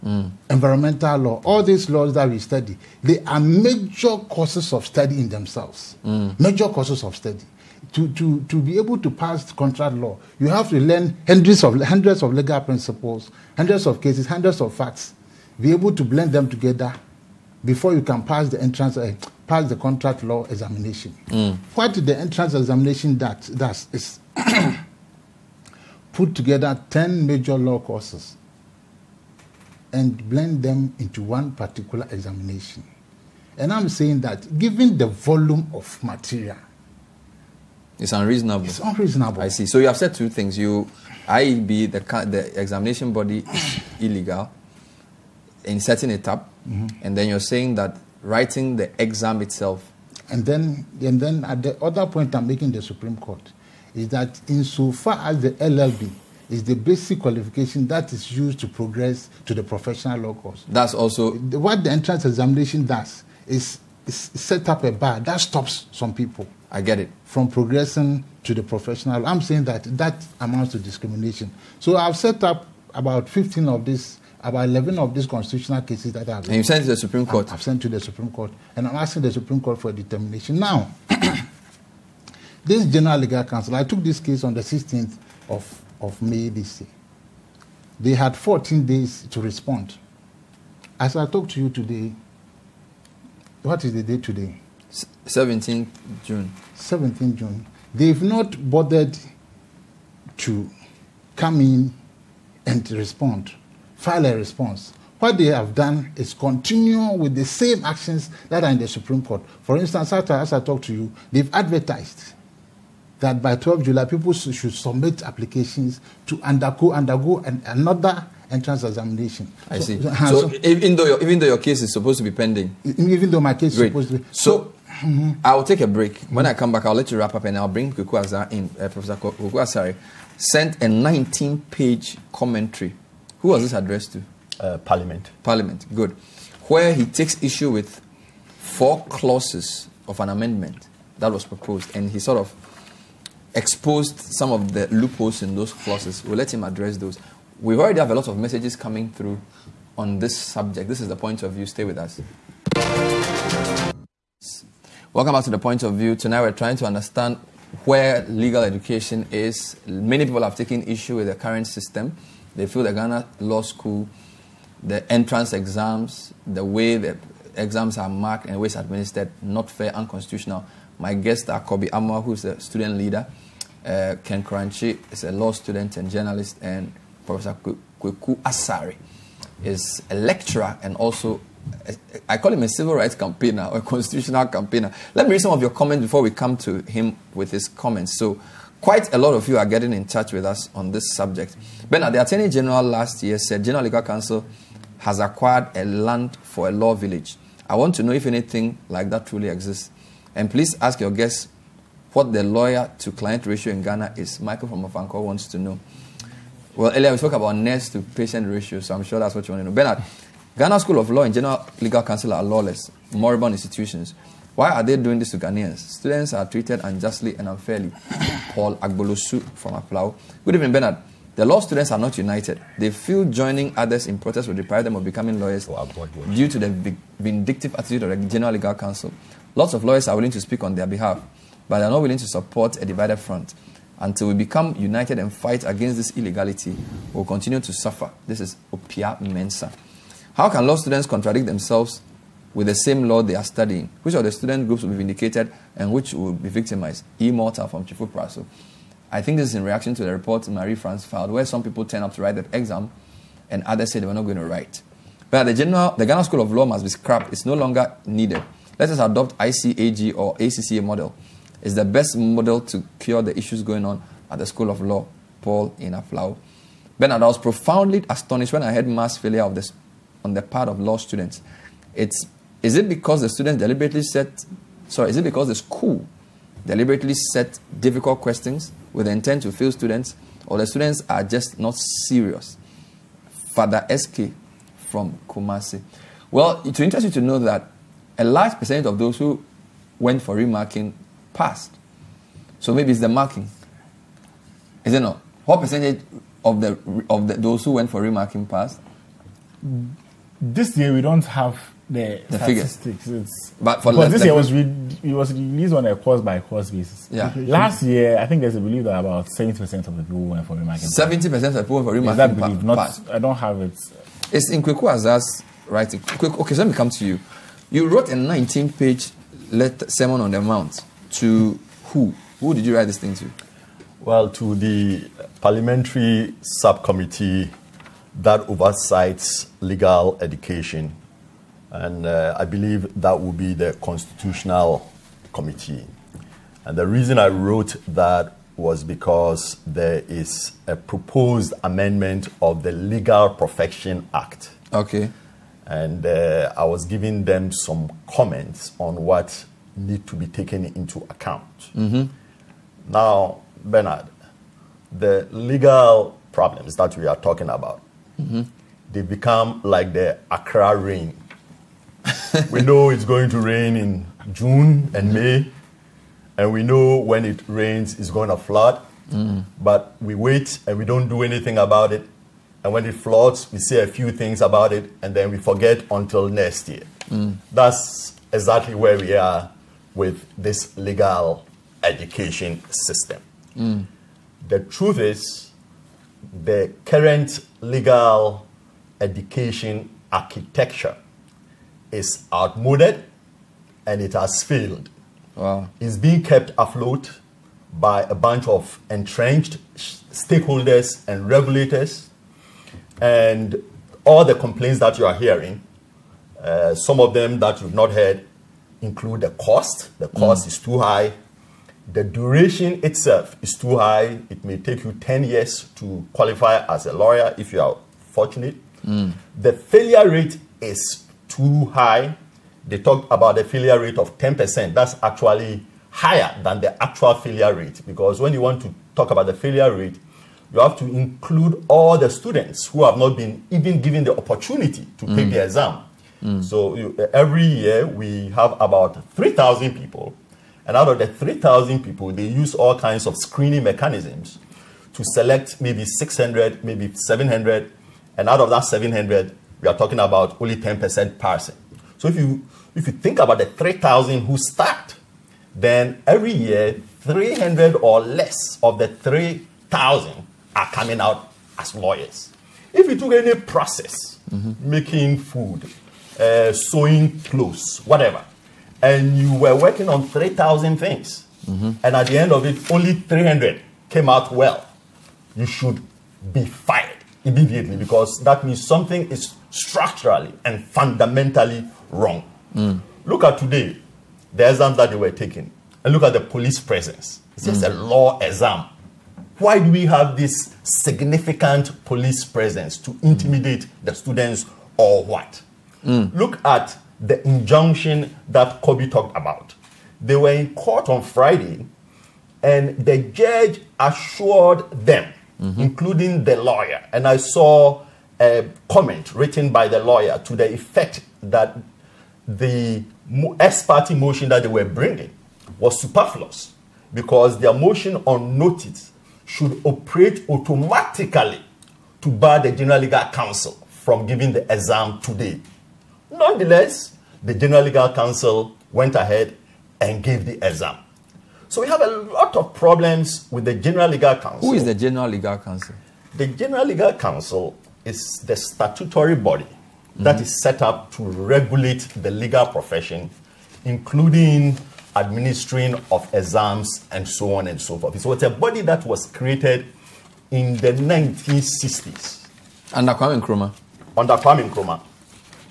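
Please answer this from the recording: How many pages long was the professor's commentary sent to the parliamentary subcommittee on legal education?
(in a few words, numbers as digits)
19.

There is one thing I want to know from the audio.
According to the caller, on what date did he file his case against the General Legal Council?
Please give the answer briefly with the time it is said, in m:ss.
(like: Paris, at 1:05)
16th of May, at 1:24.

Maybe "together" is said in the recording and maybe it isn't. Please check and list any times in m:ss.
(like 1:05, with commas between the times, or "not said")
0:16, 0:26.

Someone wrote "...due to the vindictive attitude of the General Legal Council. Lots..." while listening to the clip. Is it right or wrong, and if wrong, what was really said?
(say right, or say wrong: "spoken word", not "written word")
right.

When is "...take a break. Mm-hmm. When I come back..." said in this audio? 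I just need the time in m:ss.
2:05.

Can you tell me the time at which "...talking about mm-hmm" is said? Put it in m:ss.
5:57.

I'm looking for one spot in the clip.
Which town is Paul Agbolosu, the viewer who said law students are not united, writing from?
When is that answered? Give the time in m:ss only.
3:39.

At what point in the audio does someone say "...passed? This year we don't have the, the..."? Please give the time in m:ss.
4:58.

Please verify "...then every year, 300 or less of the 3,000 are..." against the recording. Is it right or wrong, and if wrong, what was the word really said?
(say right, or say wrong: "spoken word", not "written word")
right.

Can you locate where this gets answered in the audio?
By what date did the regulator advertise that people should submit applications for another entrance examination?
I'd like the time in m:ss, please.
1:53.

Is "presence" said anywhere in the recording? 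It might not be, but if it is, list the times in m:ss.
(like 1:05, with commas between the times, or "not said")
8:06, 8:12.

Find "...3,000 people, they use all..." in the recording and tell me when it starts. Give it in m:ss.
7:21.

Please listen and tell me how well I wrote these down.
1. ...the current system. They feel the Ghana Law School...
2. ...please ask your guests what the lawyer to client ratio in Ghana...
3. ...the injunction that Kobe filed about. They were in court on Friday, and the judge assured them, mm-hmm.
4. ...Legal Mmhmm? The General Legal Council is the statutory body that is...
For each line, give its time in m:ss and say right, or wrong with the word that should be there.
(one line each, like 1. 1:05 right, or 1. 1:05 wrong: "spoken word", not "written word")
1. 2:41 right
2. 3:20 right
3. 8:16 wrong: "talked", not "filed"
4. 8:55 wrong: "Council", not "Mmhmm".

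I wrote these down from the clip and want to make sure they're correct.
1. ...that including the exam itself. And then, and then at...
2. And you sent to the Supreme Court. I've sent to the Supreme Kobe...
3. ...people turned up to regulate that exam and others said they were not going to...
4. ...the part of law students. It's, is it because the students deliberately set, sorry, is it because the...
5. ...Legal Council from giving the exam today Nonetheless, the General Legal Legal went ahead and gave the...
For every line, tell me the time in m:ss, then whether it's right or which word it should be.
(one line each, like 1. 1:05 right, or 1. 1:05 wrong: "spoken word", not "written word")
1. 0:47 wrong: "writing", not "including"
2. 1:16 wrong: "Court", not "Kobe"
3. 4:11 wrong: "write", not "regulate"
4. 4:30 right
5. 8:42 wrong: "Council", not "Legal".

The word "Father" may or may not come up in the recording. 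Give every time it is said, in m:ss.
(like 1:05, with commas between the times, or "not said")
4:43.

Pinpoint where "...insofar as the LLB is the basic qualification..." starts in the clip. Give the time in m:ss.
0:54.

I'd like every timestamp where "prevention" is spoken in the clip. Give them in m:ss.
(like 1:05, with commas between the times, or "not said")
not said.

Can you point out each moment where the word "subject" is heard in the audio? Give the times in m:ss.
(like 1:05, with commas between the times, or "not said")
2:30, 3:11.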